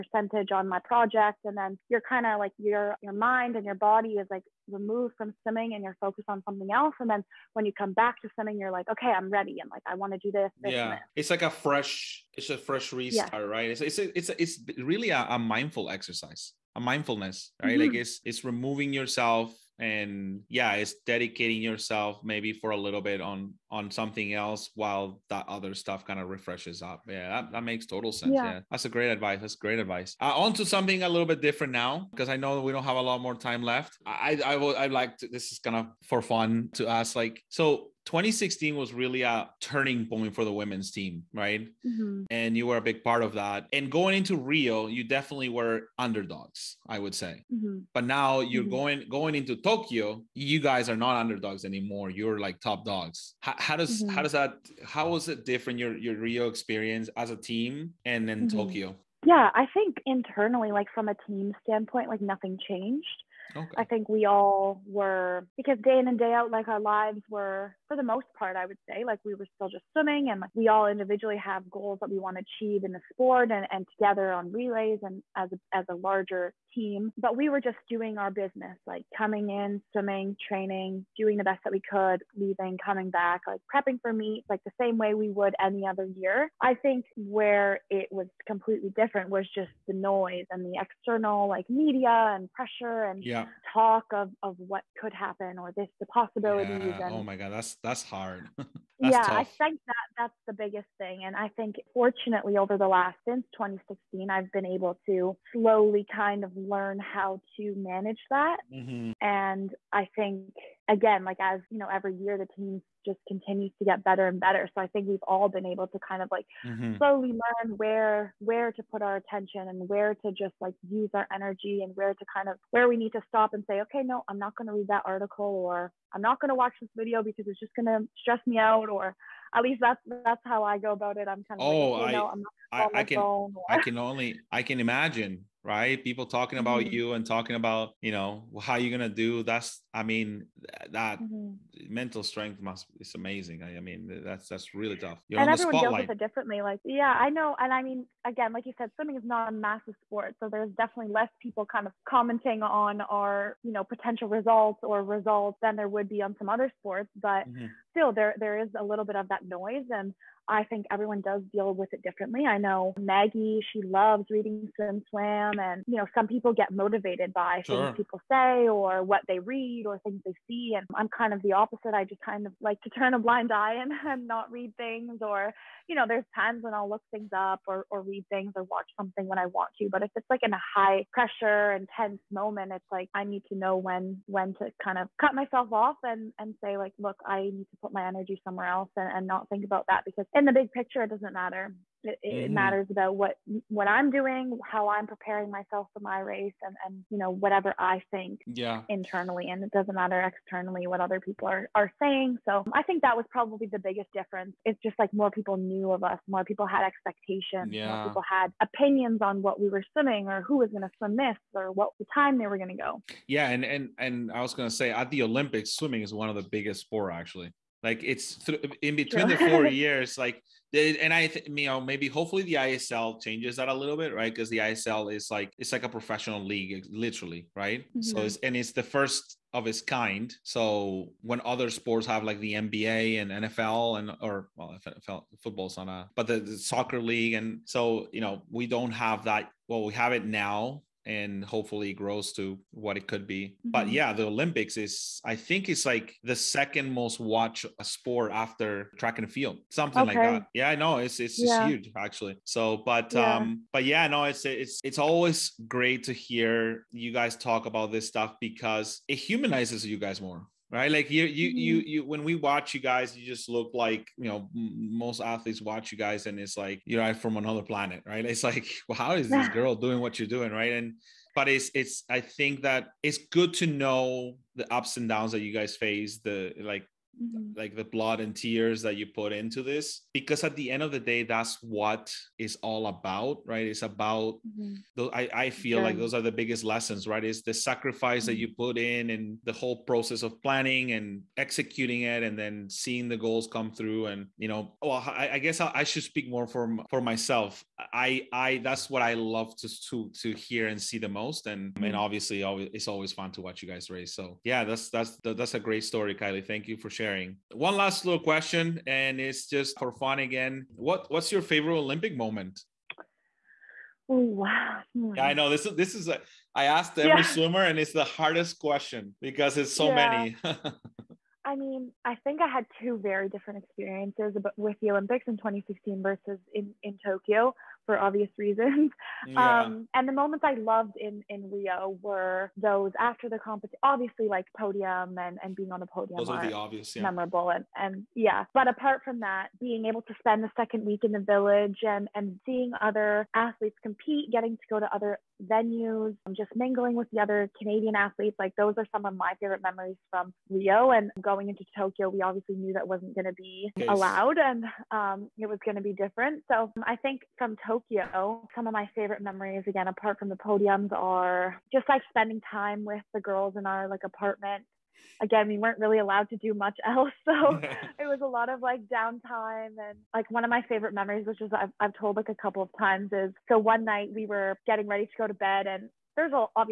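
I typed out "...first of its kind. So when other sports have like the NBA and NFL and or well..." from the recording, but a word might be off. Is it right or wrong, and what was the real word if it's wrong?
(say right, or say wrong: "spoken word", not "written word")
right.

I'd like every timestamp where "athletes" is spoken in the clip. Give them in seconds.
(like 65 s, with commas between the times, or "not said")
265 s, 343 s, 347 s.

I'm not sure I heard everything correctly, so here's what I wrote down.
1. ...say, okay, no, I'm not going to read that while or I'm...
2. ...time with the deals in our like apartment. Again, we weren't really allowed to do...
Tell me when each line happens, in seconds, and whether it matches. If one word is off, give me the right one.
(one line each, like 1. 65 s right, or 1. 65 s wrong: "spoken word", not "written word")
1. 123 s wrong: "article", not "while"
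2. 362 s wrong: "girls", not "deals".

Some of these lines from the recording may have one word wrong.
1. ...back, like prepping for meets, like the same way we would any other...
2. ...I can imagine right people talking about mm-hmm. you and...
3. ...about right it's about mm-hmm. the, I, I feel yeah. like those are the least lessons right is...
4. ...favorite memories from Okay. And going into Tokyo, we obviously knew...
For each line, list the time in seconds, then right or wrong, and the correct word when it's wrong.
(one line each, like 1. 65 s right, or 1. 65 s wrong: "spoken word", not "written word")
1. 83 s right
2. 134 s right
3. 282 s wrong: "biggest", not "least"
4. 349 s wrong: "Rio", not "Okay".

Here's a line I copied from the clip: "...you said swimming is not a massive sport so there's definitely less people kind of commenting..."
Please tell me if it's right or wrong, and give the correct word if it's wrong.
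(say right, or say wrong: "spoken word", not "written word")
right.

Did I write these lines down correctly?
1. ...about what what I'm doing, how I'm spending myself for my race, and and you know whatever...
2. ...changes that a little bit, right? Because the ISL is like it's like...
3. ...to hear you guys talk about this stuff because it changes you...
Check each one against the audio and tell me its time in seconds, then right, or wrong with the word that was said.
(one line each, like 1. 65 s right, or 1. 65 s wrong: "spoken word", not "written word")
1. 192 s wrong: "preparing", not "spending"
2. 223 s right
3. 256 s wrong: "humanizes", not "changes".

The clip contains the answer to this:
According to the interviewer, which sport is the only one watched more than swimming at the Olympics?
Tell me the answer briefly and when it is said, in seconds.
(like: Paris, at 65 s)
Track and field, at 248 s.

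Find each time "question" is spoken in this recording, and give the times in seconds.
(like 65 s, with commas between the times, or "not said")
308 s, 318 s.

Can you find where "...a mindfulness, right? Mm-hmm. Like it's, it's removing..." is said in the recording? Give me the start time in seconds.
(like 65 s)
16 s.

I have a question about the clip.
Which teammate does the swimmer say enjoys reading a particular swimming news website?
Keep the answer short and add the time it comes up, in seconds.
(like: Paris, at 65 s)
Maggie, at 162 s.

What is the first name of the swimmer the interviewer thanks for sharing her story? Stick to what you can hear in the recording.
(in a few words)
Kylie.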